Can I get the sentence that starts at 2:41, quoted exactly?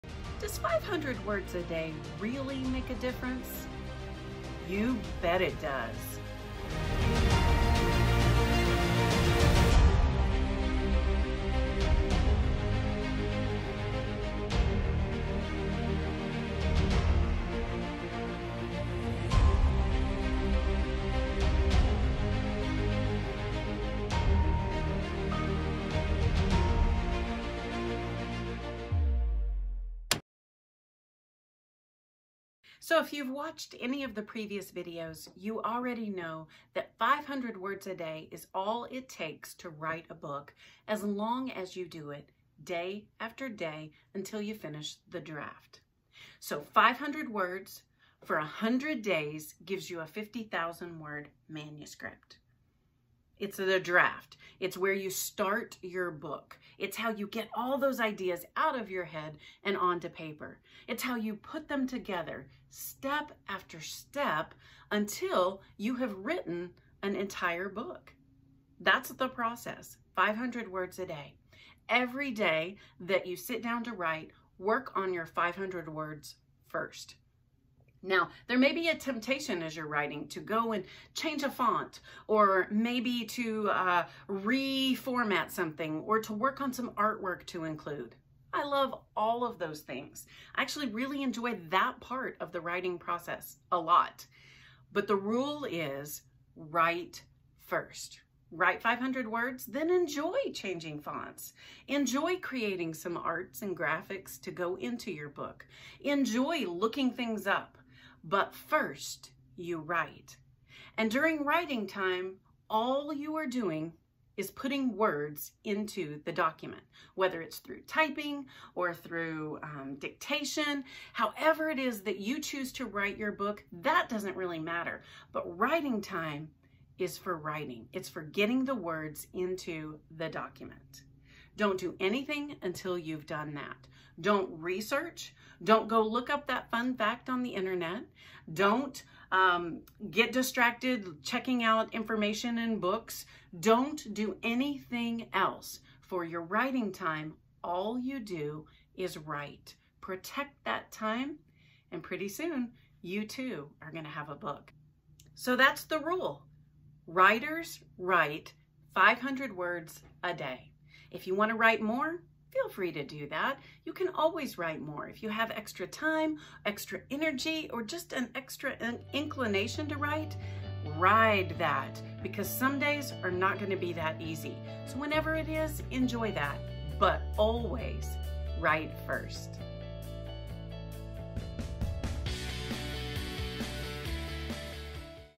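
If you want to write more, feel free to do that.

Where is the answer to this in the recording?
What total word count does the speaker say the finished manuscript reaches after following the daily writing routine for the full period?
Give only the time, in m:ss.
0:50.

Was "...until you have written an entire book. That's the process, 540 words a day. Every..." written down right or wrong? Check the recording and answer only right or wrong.
wrong.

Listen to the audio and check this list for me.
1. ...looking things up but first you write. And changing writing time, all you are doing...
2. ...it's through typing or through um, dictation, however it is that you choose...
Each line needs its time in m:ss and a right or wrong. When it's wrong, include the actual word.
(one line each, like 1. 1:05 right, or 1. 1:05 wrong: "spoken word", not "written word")
1. 1:46 wrong: "during", not "changing"
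2. 1:57 right.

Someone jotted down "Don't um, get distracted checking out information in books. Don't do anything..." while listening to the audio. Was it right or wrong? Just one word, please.
right.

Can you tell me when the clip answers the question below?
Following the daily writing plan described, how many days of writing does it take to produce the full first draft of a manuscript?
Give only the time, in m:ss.
0:48.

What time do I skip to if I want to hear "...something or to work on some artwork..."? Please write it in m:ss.
1:25.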